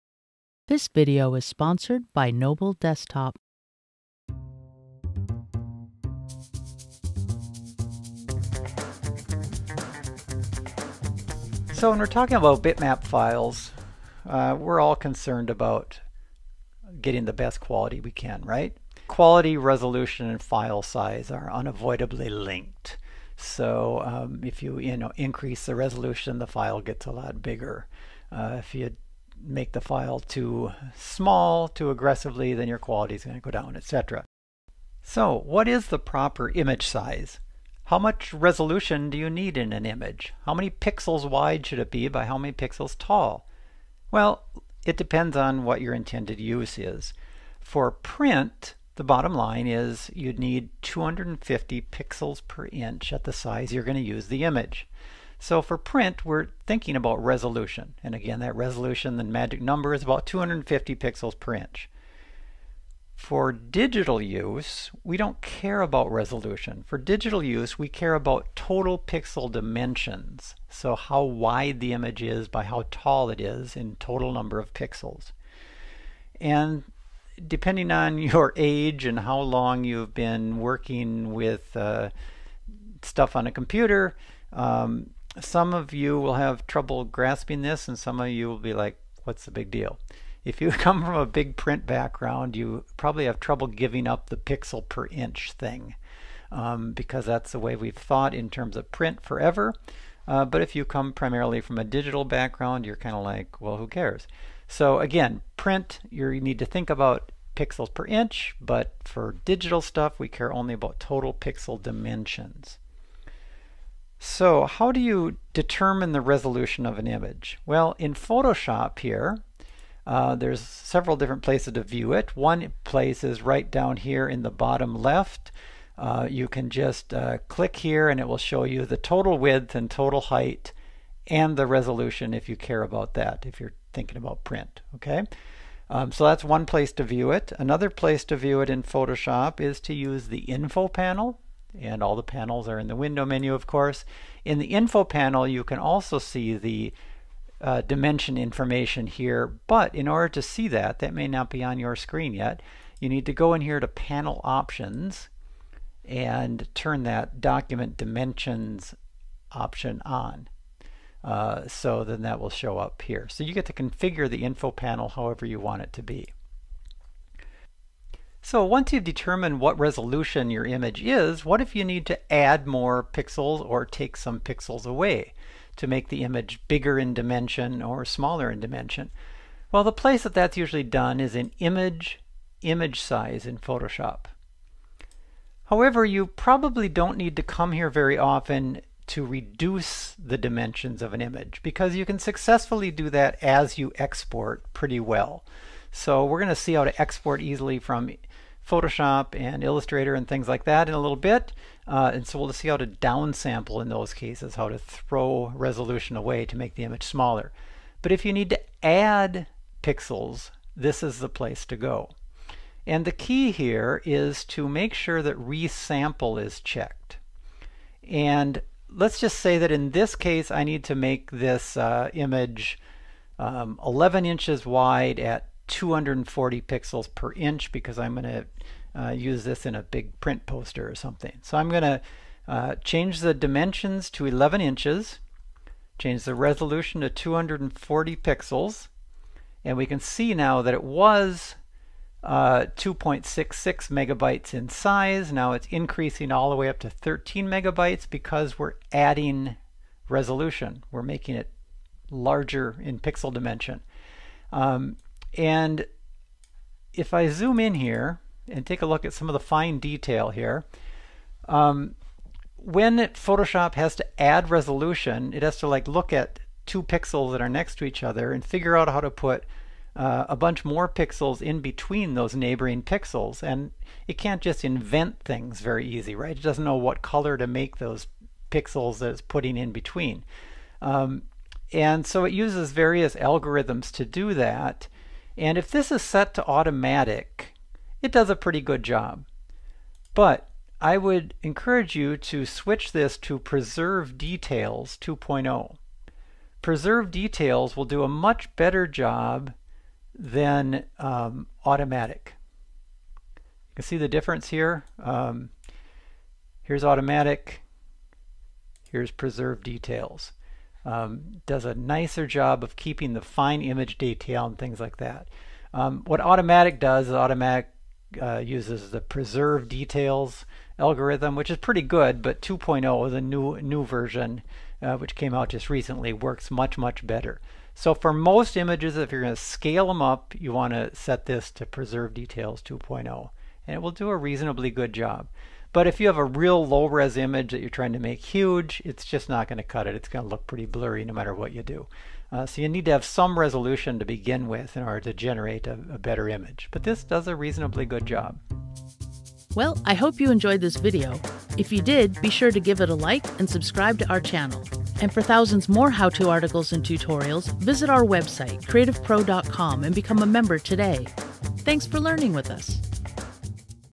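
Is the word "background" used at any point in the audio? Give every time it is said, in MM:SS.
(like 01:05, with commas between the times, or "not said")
01:31, 01:42.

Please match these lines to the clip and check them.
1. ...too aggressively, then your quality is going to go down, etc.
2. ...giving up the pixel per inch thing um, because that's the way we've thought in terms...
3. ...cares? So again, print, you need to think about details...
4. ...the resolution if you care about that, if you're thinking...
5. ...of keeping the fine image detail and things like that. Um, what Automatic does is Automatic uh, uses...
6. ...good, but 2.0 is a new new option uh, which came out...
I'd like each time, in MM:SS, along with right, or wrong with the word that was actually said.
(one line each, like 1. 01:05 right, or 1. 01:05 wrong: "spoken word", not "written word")
1. 00:31 right
2. 01:33 right
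3. 01:43 wrong: "pixels", not "details"
4. 02:11 right
5. 05:12 right
6. 05:21 wrong: "version", not "option".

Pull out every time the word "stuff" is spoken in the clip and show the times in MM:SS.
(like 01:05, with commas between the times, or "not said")
01:23, 01:49.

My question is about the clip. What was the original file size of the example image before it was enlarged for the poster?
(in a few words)
2.66 megabytes.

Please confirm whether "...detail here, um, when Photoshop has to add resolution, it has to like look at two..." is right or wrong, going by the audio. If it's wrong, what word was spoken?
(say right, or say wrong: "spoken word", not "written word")
right.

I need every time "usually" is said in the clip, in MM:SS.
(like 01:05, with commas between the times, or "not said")
03:00.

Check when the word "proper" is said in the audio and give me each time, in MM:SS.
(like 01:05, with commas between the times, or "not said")
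00:35.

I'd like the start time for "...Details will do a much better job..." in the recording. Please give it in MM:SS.
04:57.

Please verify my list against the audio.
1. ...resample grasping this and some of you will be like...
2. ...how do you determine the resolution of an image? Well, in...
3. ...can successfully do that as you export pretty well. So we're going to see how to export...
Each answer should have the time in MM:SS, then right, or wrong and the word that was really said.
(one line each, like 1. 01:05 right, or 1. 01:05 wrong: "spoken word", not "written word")
1. 01:26 wrong: "trouble", not "resample"
2. 01:54 right
3. 03:12 right.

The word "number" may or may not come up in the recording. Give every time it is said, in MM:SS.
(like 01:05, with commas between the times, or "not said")
00:59, 01:14.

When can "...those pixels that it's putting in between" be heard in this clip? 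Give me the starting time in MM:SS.
04:37.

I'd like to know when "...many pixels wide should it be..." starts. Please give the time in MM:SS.
00:40.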